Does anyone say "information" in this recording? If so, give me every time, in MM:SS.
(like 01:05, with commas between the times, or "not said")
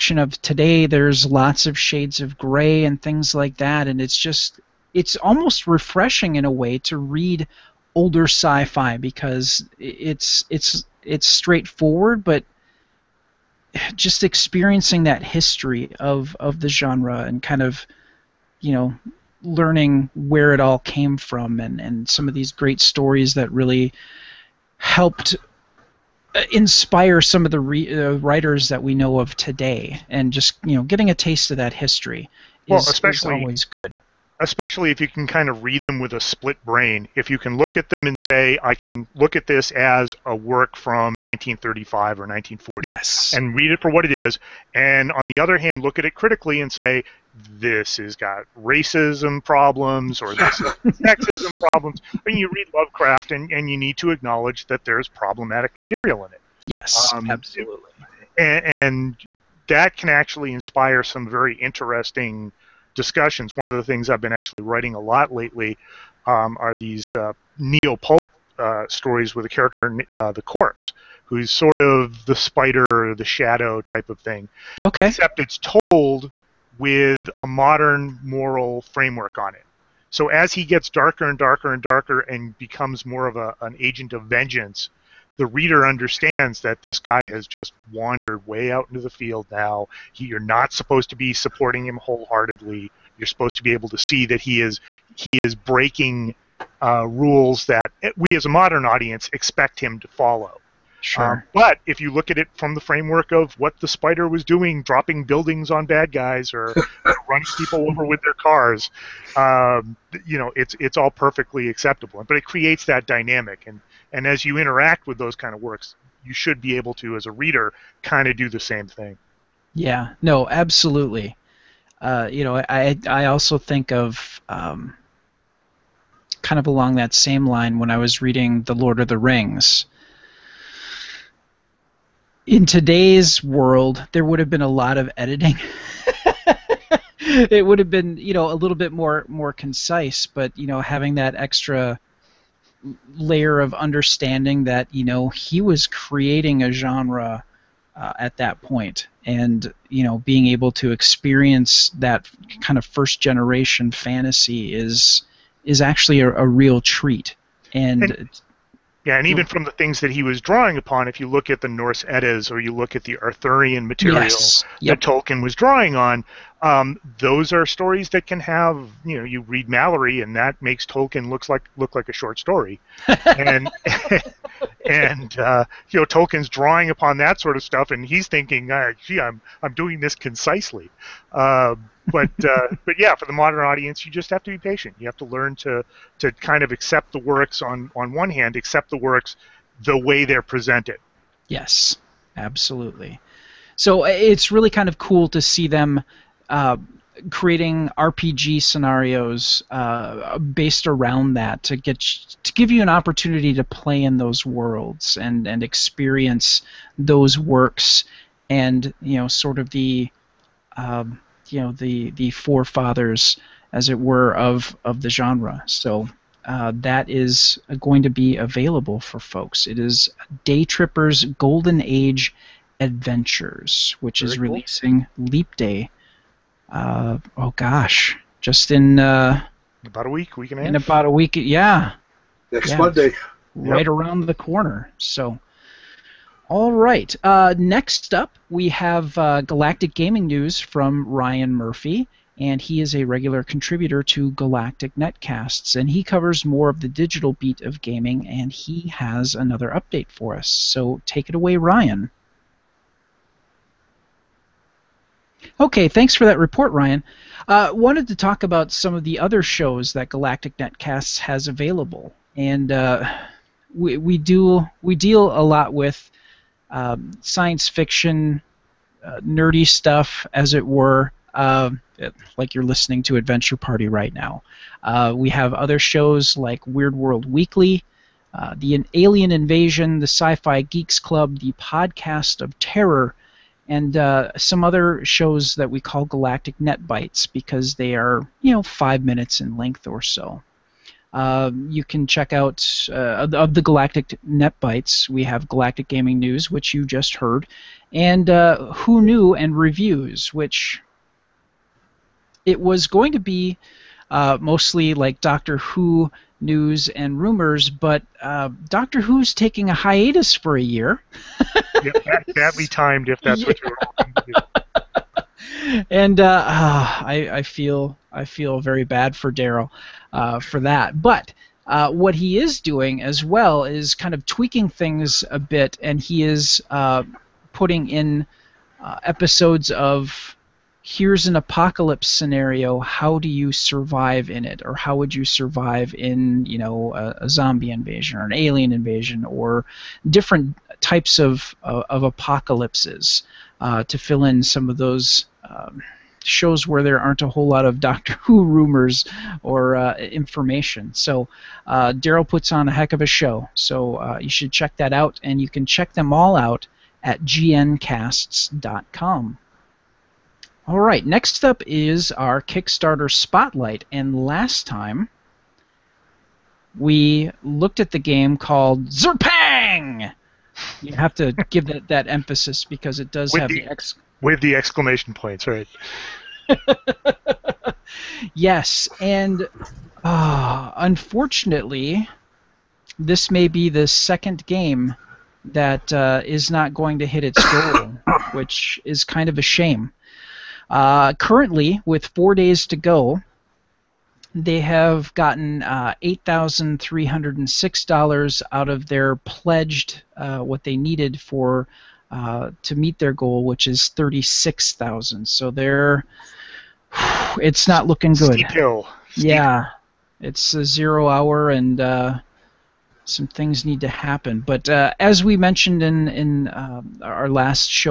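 05:49.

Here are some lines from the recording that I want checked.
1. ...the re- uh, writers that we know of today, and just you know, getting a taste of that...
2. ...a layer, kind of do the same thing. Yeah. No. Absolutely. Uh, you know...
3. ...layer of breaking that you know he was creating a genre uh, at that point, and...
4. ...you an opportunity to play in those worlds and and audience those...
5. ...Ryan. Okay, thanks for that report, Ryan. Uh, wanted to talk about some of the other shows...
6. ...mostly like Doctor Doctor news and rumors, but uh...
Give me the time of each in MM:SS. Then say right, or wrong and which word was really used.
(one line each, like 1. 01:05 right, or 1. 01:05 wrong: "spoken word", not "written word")
1. 00:27 right
2. 01:57 wrong: "reader", not "layer"
3. 02:23 wrong: "understanding", not "breaking"
4. 03:22 wrong: "experience", not "audience"
5. 04:11 right
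6. 05:04 wrong: "Who", not "Doctor".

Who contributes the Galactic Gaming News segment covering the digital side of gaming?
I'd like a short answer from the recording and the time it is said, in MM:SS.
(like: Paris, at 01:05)
Ryan Murphy, at 04:01.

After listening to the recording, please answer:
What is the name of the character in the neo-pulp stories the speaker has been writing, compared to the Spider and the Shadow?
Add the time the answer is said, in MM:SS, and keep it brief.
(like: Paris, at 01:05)
The Corpse, at 01:10.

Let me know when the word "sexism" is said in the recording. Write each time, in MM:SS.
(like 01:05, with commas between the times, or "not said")
00:50.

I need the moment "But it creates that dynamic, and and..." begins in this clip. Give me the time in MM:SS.
01:52.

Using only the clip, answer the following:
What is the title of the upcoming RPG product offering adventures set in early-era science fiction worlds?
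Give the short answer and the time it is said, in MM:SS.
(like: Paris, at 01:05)
Day Trippers Golden Age Adventures, at 03:40.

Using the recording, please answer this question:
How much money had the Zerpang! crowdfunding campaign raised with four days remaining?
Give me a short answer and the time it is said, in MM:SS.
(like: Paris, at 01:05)
$8,306, at 06:36.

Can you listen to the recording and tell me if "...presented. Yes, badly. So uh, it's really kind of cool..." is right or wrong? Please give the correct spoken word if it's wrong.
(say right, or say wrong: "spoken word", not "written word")
wrong: "absolutely", not "badly".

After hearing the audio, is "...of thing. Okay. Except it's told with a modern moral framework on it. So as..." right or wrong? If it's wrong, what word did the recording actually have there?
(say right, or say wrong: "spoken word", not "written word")
right.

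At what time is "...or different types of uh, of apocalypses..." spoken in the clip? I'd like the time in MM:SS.
05:39.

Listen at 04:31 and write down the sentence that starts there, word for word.
Uh, like you're listening to Adventure Party right now.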